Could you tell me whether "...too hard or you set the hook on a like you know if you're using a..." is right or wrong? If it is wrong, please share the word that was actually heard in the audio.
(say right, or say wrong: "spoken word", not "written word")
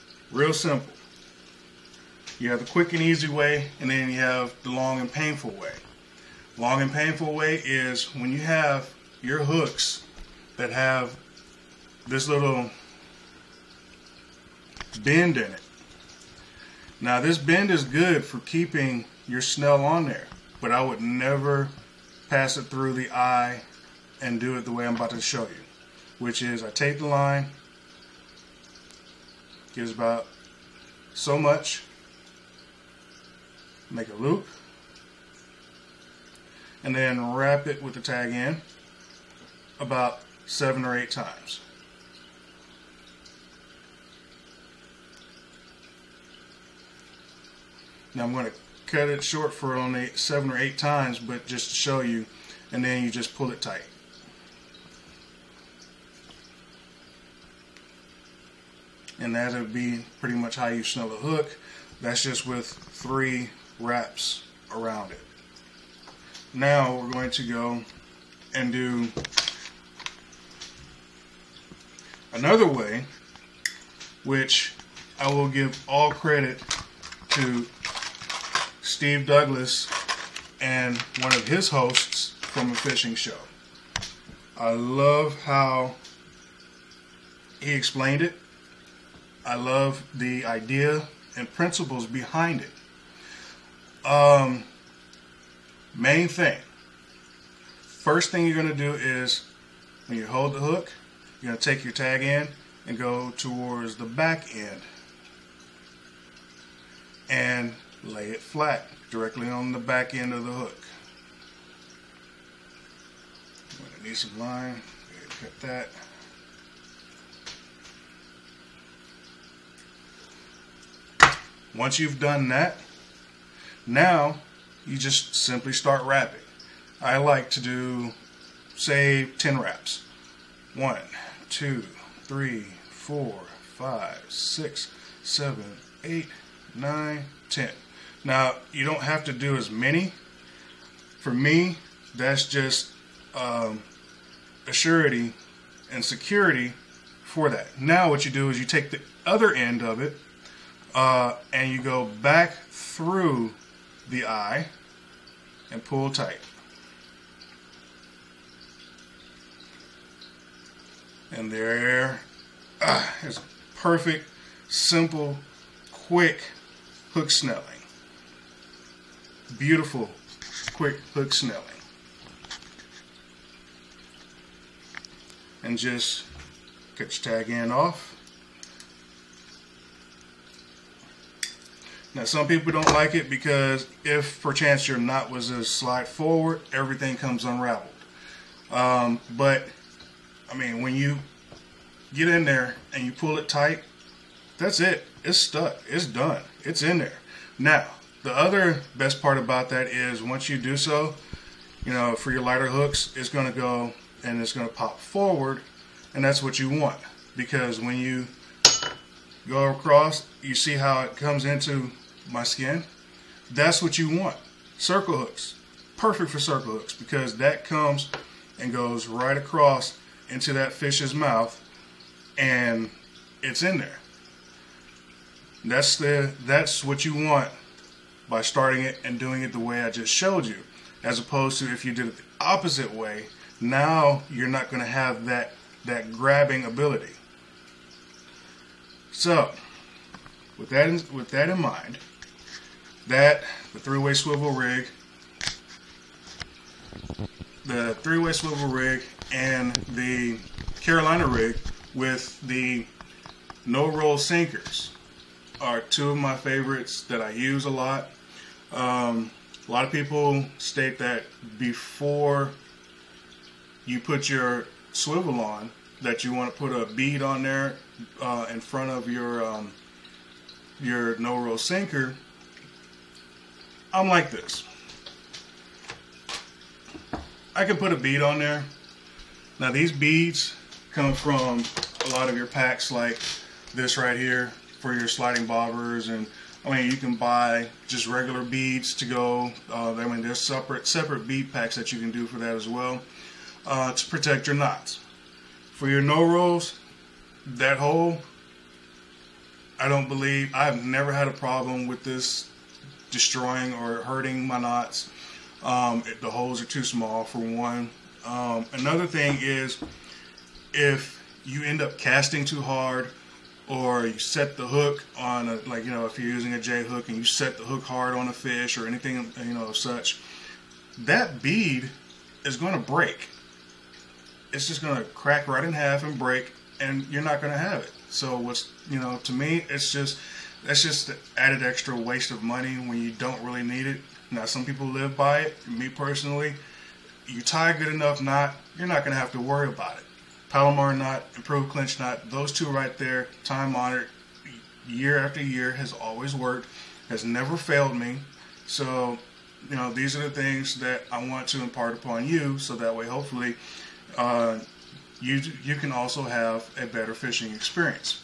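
right.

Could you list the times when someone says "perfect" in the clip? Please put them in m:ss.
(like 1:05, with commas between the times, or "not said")
2:43, 3:35.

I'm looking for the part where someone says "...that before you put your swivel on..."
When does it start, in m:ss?
4:20.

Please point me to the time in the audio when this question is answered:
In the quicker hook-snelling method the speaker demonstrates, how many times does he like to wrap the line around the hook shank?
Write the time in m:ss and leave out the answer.
2:09.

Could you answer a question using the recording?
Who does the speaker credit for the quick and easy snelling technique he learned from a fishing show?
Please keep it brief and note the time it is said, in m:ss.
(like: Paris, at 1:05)
Steve Douglas, at 1:18.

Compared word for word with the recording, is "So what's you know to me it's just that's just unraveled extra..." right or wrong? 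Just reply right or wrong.
wrong.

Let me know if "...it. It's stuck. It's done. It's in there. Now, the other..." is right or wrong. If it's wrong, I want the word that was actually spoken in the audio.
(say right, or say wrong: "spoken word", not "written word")
right.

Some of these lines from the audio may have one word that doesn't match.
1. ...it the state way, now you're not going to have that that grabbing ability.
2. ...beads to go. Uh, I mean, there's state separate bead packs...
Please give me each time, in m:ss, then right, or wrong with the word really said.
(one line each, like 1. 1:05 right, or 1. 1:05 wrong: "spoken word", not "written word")
1. 3:52 wrong: "opposite", not "state"
2. 4:48 wrong: "separate", not "state".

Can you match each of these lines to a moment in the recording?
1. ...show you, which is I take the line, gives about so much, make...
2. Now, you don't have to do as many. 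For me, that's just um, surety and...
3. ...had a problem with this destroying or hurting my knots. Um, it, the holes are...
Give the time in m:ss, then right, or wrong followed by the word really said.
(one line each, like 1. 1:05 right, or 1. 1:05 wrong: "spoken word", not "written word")
1. 0:25 right
2. 2:18 right
3. 5:01 right.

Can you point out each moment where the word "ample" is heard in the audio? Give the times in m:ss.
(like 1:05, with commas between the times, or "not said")
not said.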